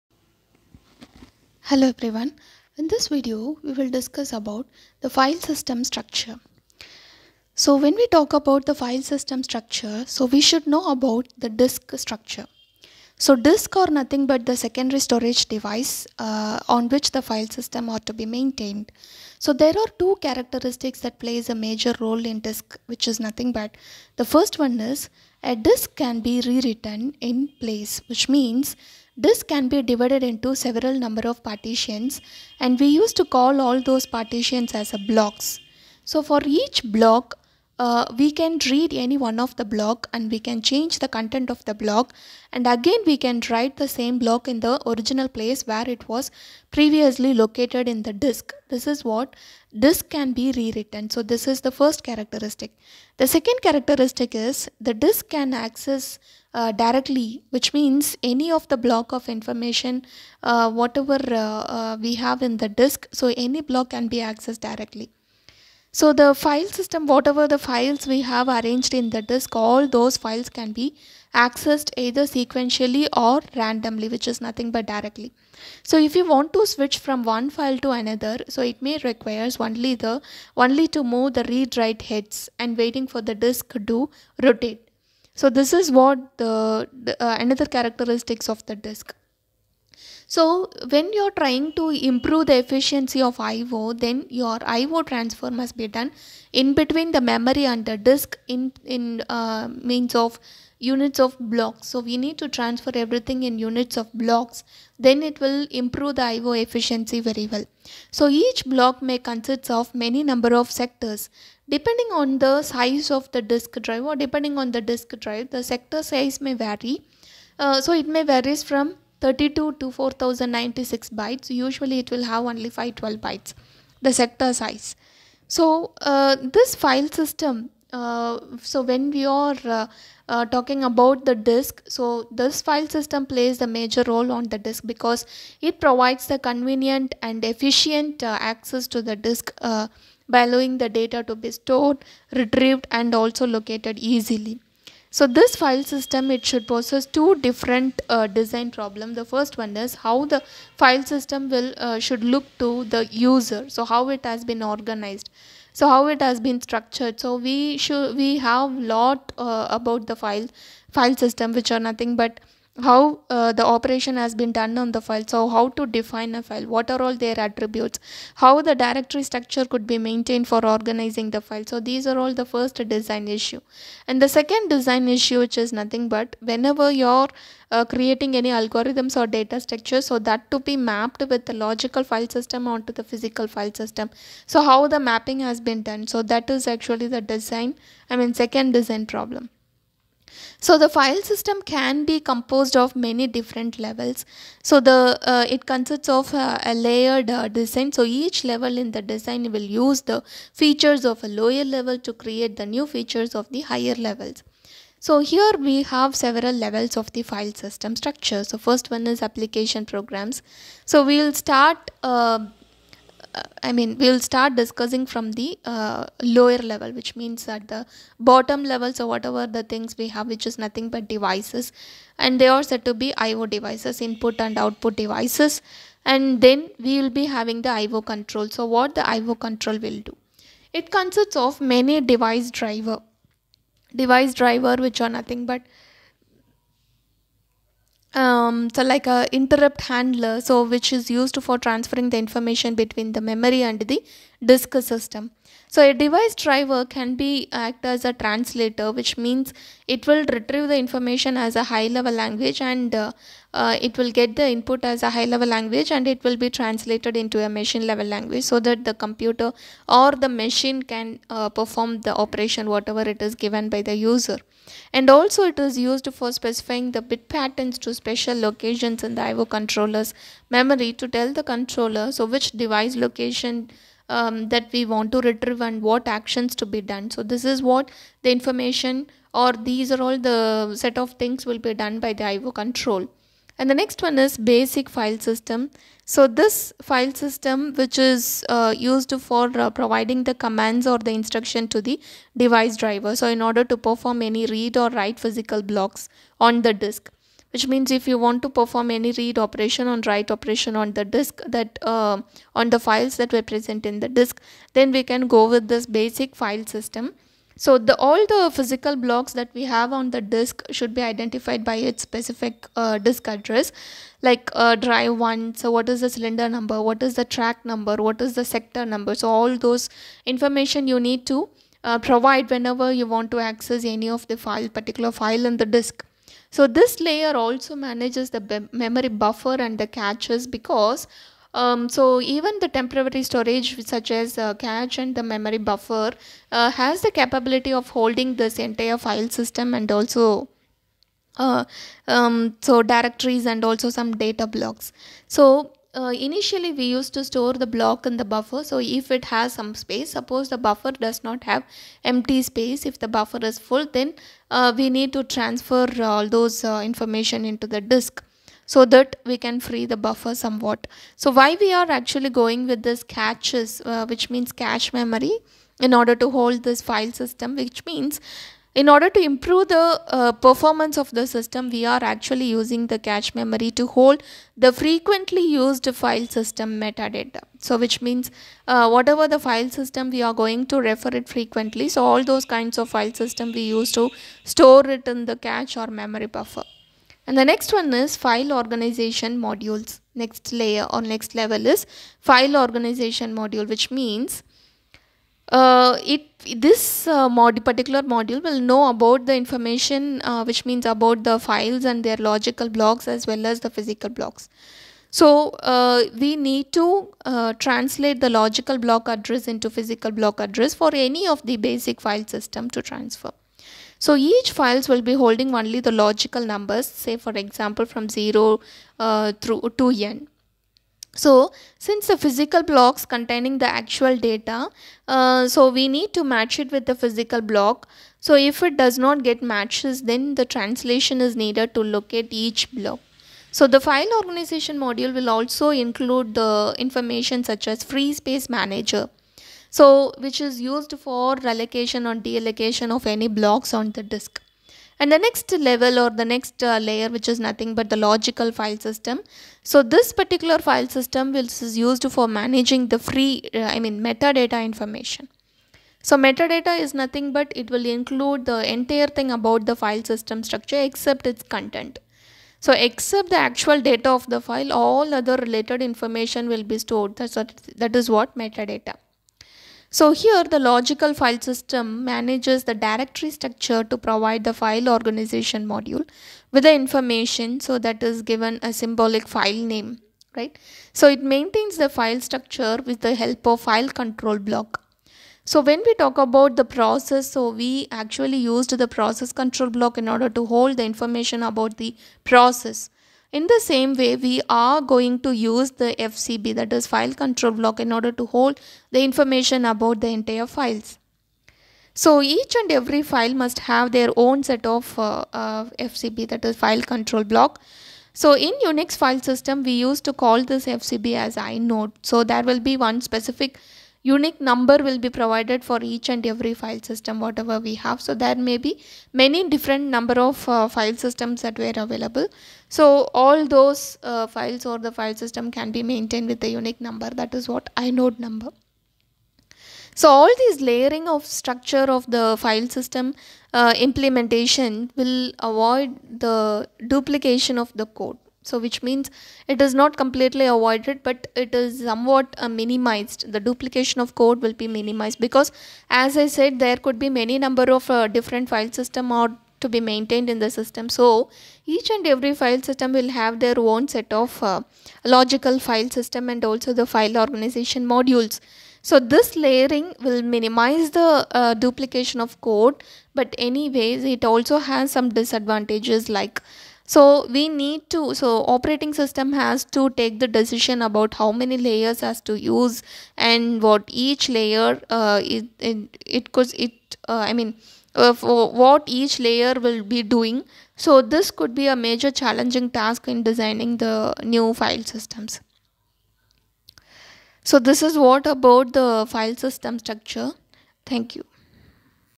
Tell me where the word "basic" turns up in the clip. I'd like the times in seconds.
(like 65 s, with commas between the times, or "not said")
284 s, 305 s, 411 s.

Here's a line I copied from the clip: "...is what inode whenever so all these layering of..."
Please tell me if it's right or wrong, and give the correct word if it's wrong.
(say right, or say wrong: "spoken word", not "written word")
wrong: "number", not "whenever".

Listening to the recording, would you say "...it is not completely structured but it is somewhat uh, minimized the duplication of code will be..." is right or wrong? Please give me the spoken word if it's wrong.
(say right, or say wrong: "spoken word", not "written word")
wrong: "avoided", not "structured".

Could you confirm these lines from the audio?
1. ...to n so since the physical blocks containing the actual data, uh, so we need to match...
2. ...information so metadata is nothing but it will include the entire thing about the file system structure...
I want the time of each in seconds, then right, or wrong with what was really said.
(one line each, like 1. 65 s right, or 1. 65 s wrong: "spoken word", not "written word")
1. 419 s right
2. 454 s right.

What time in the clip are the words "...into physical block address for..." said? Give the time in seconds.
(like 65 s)
409 s.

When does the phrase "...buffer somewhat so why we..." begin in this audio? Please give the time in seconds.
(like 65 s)
359 s.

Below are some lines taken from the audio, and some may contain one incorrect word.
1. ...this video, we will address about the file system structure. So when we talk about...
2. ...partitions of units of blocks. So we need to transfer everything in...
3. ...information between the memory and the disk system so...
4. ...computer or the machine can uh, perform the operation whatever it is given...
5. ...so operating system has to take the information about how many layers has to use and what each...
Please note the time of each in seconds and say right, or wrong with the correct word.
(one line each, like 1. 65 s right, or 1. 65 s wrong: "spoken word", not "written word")
1. 2 s wrong: "discuss", not "address"
2. 99 s wrong: "means", not "partitions"
3. 242 s right
4. 258 s right
5. 568 s wrong: "decision", not "information".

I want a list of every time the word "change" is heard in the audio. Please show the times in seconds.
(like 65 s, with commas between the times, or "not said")
40 s.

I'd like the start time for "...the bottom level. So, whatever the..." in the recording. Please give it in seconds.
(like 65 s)
217 s.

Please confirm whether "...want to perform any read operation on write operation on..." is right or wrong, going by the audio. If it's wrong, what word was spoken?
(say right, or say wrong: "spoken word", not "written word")
right.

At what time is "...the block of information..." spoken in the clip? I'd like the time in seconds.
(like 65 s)
58 s.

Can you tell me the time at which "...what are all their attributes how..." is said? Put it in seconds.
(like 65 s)
166 s.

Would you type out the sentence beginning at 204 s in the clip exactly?
So here we have several levels of the file system structure.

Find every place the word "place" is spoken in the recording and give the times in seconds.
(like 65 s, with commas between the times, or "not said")
27 s, 45 s.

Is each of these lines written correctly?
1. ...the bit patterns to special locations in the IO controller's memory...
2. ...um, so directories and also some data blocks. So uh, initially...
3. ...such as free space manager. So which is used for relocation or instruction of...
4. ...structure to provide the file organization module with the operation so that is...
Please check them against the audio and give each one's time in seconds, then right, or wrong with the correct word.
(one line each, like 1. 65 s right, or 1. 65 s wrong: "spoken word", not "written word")
1. 266 s right
2. 342 s right
3. 437 s wrong: "deallocation", not "instruction"
4. 473 s wrong: "information", not "operation".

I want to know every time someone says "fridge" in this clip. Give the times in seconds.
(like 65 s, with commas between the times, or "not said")
not said.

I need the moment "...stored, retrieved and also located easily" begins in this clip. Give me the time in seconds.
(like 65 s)
141 s.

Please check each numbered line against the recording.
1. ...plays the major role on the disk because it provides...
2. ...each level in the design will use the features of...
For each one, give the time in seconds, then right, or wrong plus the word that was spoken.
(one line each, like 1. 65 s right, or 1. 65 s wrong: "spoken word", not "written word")
1. 133 s right
2. 198 s right.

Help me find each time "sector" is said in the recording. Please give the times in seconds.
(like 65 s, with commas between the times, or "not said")
110 s, 115 s, 124 s, 318 s.